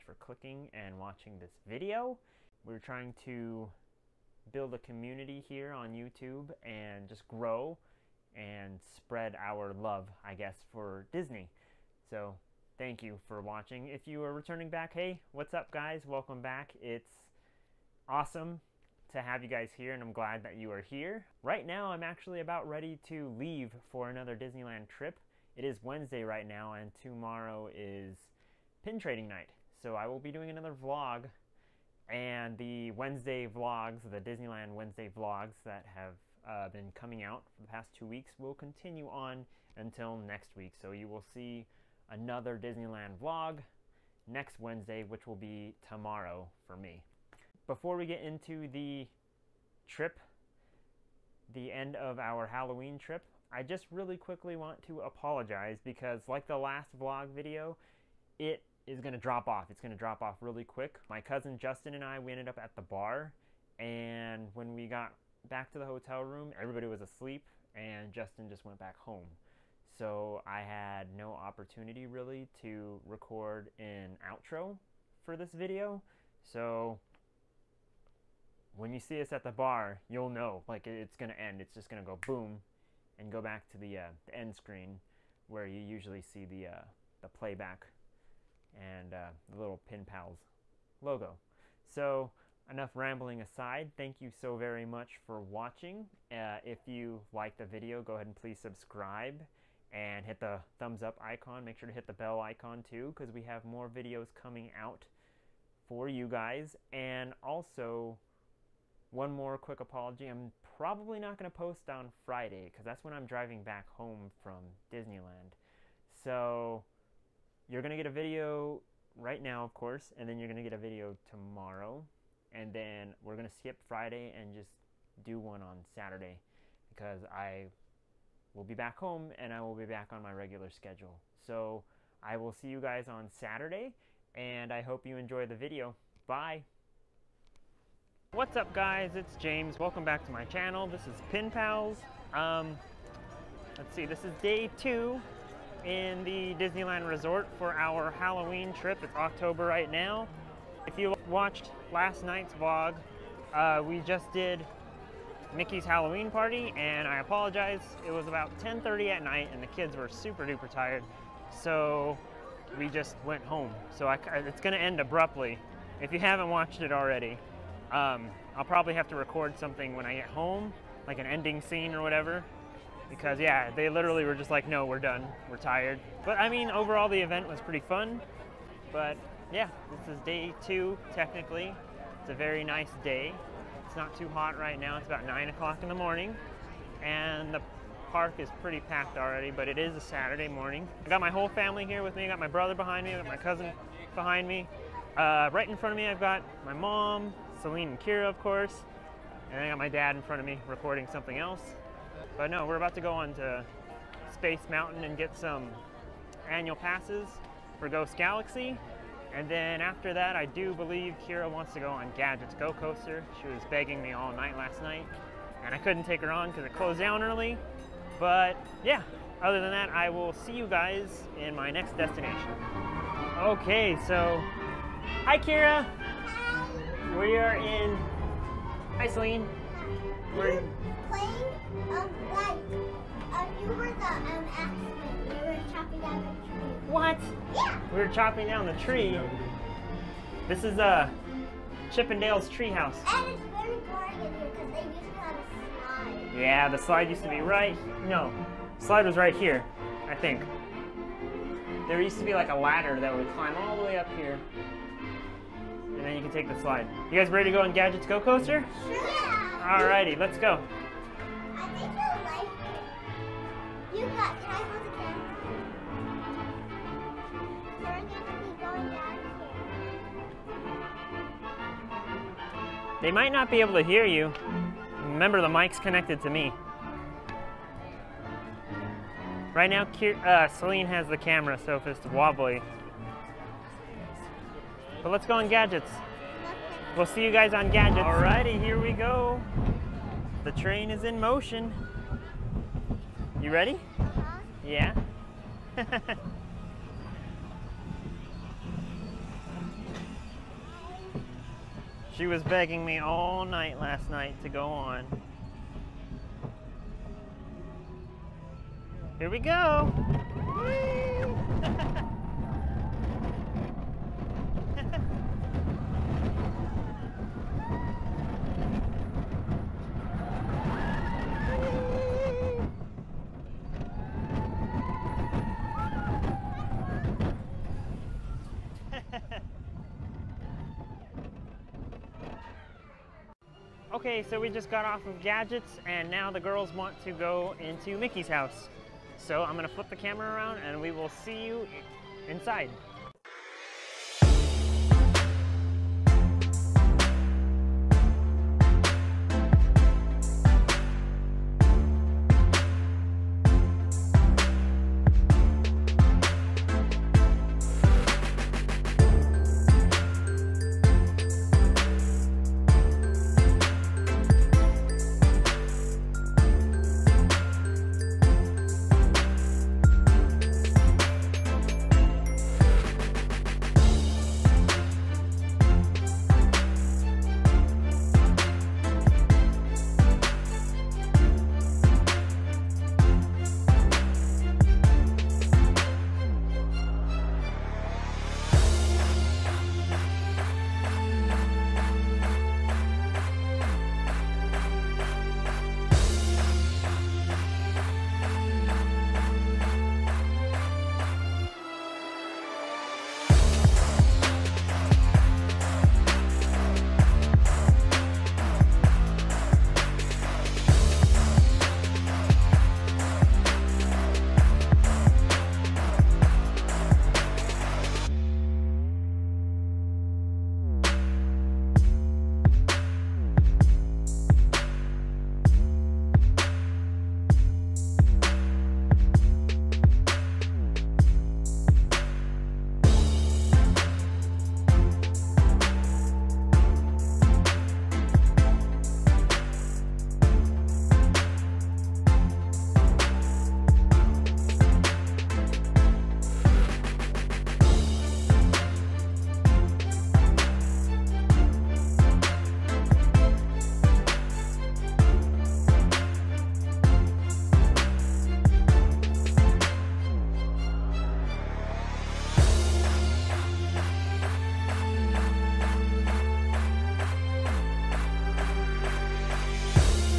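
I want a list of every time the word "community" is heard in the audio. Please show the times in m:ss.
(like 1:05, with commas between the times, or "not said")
0:04.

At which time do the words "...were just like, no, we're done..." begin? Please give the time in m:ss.
2:54.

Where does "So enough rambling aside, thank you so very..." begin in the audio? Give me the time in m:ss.
1:31.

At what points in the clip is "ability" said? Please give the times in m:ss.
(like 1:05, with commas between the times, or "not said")
not said.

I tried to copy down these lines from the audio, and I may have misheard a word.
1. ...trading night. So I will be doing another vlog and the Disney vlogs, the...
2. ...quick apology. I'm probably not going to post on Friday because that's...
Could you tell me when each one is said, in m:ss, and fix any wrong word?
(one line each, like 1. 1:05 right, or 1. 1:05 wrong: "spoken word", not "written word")
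1. 0:28 wrong: "Wednesday", not "Disney"
2. 1:49 right.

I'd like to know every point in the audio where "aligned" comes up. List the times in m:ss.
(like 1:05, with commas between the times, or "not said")
not said.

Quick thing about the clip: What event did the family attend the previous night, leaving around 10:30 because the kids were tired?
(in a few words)
Mickey's Halloween party.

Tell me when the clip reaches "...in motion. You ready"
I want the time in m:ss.
4:51.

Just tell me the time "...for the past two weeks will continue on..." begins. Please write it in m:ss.
0:37.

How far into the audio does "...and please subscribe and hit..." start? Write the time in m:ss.
1:38.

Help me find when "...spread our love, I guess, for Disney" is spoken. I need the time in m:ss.
0:08.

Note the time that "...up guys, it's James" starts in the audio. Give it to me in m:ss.
2:18.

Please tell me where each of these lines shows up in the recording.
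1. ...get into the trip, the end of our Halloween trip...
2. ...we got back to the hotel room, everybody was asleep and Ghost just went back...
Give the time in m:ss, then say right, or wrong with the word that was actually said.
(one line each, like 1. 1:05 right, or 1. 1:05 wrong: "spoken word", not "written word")
1. 0:48 right
2. 1:04 wrong: "Justin", not "Ghost".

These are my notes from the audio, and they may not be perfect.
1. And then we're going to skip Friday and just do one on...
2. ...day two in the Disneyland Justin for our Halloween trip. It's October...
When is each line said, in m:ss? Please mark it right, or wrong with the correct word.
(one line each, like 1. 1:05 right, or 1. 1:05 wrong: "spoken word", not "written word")
1. 2:02 right
2. 2:24 wrong: "Resort", not "Justin".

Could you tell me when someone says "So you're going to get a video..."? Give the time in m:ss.
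1:56.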